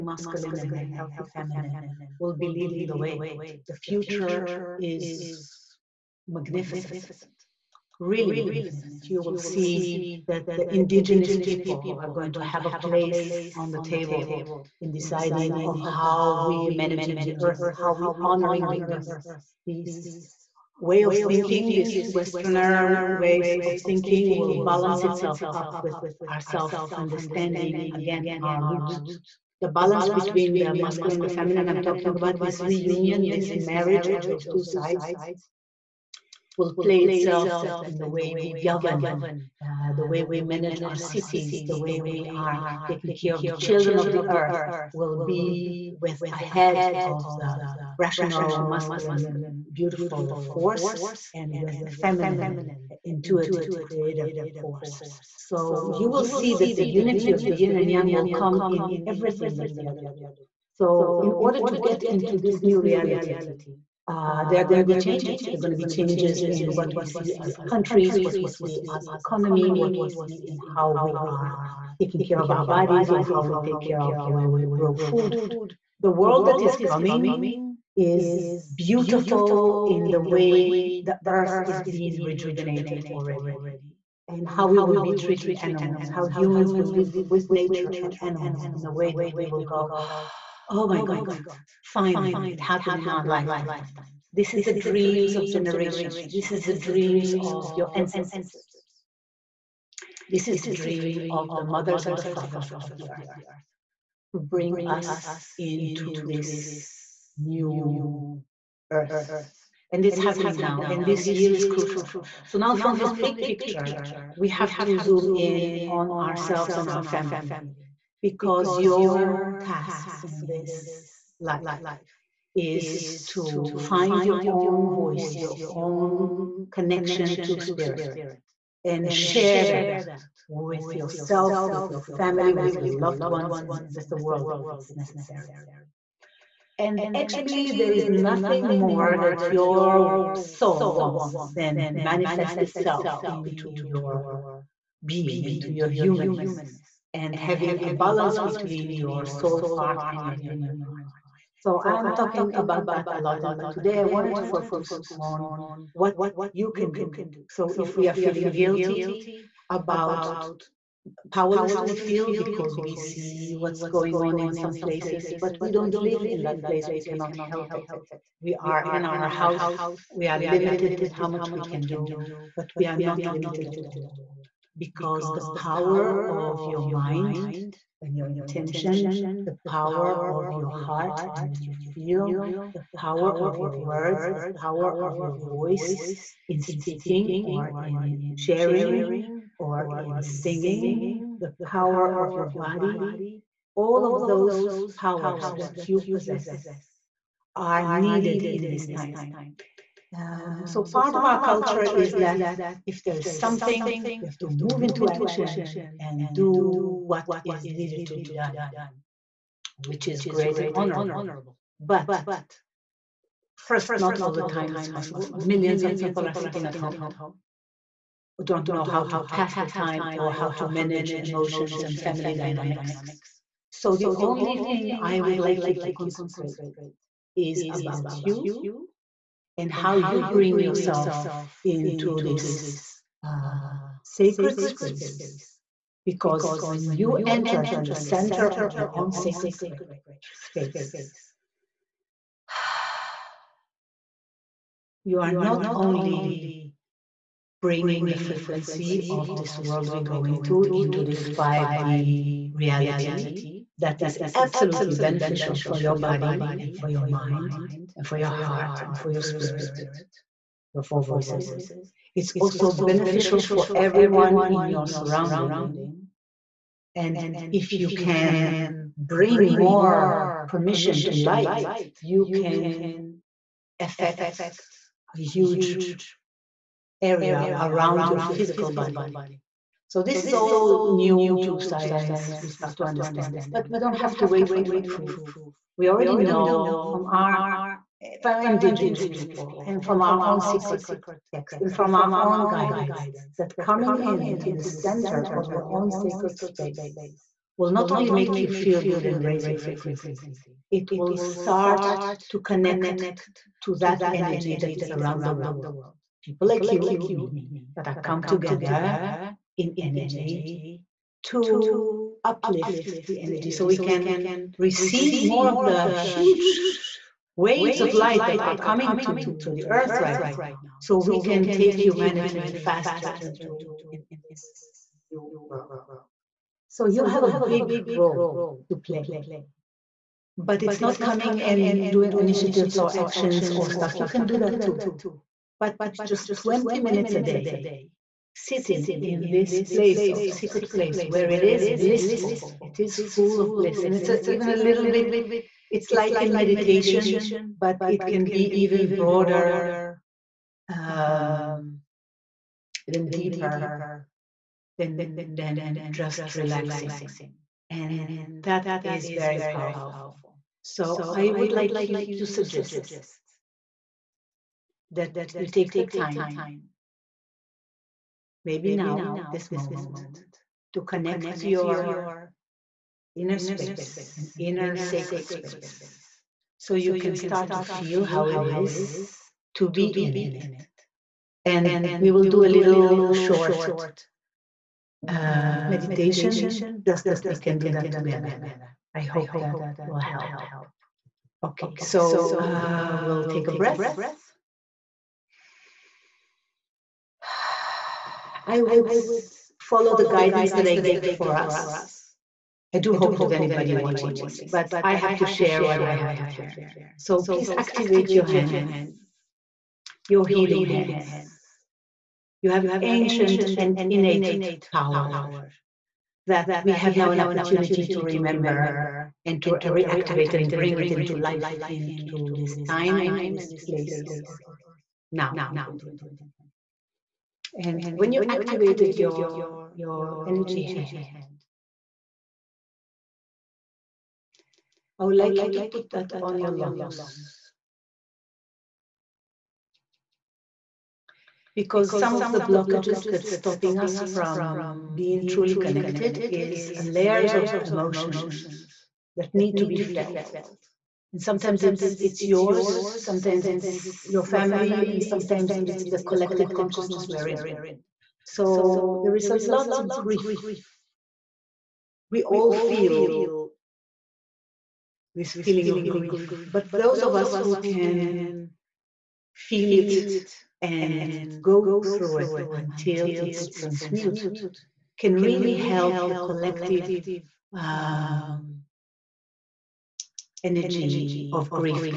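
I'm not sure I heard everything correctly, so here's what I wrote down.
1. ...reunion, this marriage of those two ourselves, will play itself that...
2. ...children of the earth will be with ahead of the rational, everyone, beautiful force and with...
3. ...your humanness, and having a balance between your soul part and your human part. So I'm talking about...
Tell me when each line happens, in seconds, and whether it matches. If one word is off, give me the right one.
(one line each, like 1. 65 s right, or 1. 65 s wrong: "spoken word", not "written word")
1. 32 s wrong: "sides", not "ourselves"
2. 43 s wrong: "masculine", not "everyone"
3. 145 s right.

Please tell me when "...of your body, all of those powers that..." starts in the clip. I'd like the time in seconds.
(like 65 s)
192 s.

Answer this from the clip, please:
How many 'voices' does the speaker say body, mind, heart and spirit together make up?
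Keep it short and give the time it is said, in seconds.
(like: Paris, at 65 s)
4, at 260 s.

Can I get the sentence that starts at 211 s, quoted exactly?
But first, not all the time it's possible.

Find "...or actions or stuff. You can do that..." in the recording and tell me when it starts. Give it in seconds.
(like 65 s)
332 s.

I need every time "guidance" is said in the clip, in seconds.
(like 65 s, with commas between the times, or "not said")
292 s, 400 s.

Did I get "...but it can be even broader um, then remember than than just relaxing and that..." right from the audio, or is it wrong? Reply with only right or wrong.
wrong.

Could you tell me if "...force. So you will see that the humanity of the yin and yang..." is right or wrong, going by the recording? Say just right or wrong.
wrong.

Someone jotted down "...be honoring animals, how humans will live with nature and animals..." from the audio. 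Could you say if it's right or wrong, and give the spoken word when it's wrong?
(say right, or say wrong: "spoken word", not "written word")
wrong: "treating", not "honoring".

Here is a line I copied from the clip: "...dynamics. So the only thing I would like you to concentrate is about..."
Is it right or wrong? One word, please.
right.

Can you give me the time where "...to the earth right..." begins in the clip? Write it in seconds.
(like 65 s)
319 s.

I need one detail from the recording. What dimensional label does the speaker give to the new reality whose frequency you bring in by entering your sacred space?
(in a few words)
5D.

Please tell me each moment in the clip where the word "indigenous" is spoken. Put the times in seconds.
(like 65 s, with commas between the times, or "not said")
10 s, 288 s.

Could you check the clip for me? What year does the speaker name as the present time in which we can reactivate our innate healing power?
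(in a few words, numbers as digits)
2020.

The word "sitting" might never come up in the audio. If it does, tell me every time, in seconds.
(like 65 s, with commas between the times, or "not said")
216 s, 338 s.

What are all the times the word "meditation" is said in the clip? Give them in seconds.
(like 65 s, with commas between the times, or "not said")
346 s, 385 s.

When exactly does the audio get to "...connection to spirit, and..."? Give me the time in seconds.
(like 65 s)
126 s.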